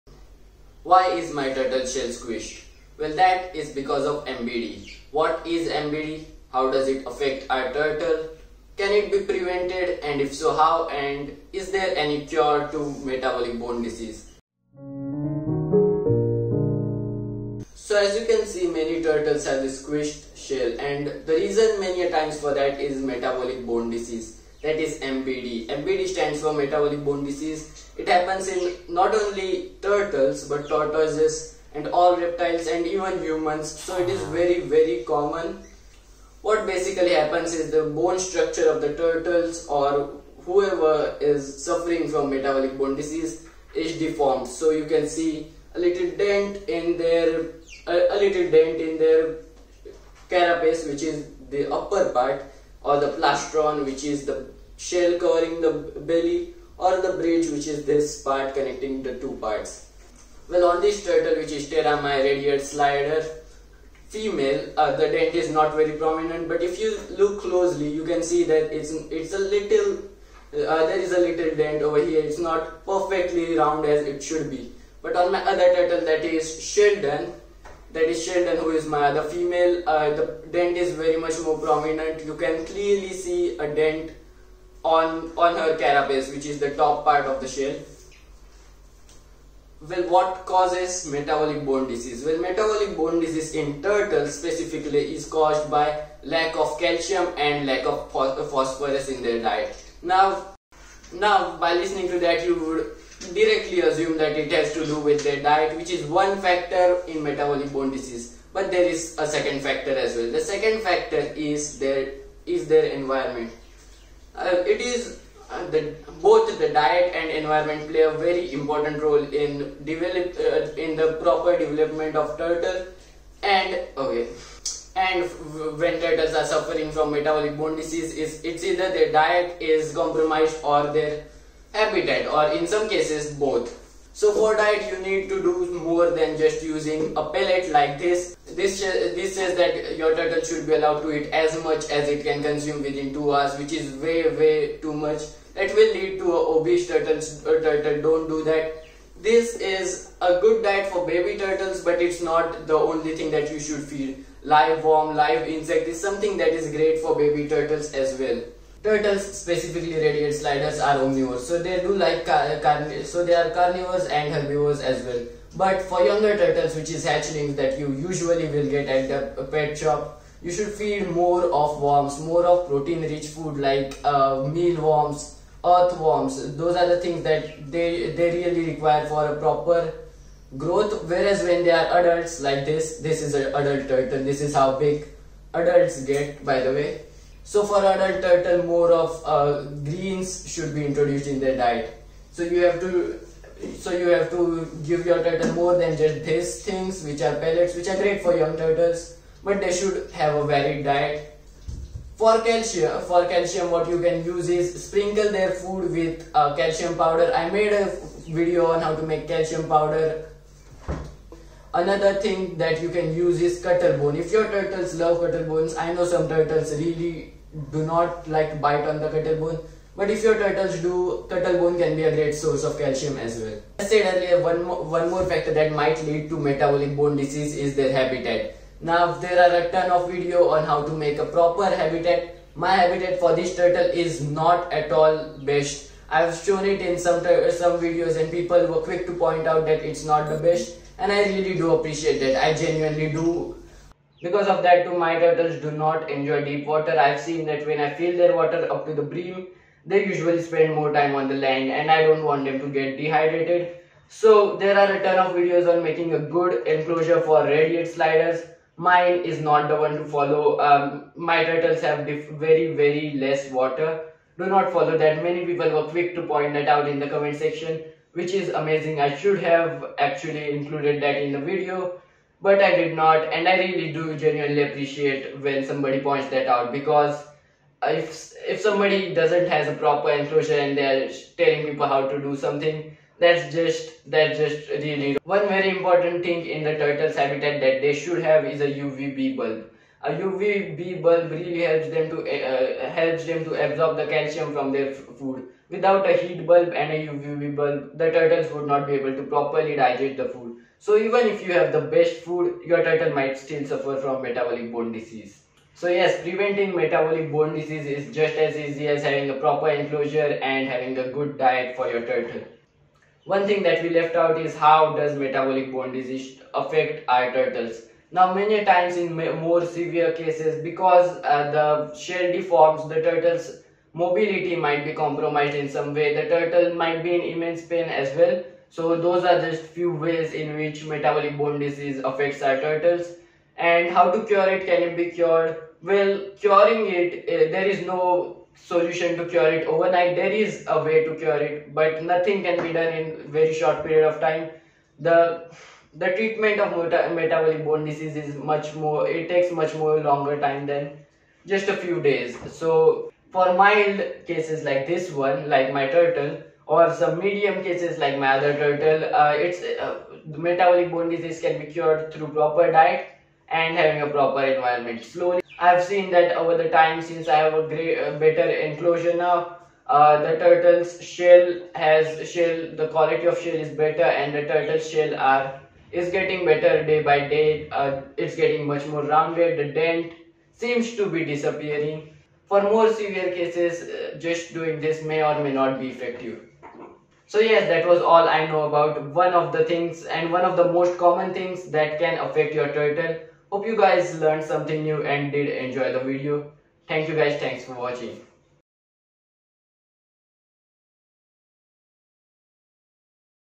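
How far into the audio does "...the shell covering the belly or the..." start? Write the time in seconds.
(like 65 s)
54 s.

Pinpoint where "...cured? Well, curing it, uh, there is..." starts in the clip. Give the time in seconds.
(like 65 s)
335 s.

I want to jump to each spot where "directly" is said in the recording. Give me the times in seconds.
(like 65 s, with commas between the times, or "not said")
103 s.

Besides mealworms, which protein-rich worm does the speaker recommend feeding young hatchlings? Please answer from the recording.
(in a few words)
earthworms.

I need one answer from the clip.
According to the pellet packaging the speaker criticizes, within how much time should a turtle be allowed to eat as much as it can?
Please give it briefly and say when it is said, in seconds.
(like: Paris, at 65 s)
2 hours, at 143 s.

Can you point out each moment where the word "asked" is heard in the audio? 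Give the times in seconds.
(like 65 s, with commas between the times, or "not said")
not said.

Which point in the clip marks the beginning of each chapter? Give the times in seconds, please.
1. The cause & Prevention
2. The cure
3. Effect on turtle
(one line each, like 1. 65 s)
1. 88 s
2. 333 s
3. 312 s.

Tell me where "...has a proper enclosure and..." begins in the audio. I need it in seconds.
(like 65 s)
279 s.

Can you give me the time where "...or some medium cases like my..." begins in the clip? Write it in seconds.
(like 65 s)
356 s.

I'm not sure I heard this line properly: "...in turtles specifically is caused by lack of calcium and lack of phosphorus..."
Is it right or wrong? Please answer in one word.
right.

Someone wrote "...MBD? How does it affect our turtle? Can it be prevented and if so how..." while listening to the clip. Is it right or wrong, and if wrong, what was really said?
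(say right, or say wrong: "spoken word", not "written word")
right.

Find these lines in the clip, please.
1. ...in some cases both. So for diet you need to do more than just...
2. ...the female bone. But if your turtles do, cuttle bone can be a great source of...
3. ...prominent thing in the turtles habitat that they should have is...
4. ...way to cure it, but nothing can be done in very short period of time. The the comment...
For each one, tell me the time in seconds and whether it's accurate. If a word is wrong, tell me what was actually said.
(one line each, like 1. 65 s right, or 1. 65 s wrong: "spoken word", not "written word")
1. 132 s right
2. 218 s wrong: "cuttle", not "female"
3. 285 s wrong: "important", not "prominent"
4. 340 s wrong: "treatment", not "comment".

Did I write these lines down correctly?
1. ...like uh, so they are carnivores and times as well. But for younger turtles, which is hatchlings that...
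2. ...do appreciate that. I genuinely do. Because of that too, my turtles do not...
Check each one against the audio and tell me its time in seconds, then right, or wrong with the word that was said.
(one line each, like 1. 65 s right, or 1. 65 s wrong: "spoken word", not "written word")
1. 161 s wrong: "herbivores", not "times"
2. 241 s right.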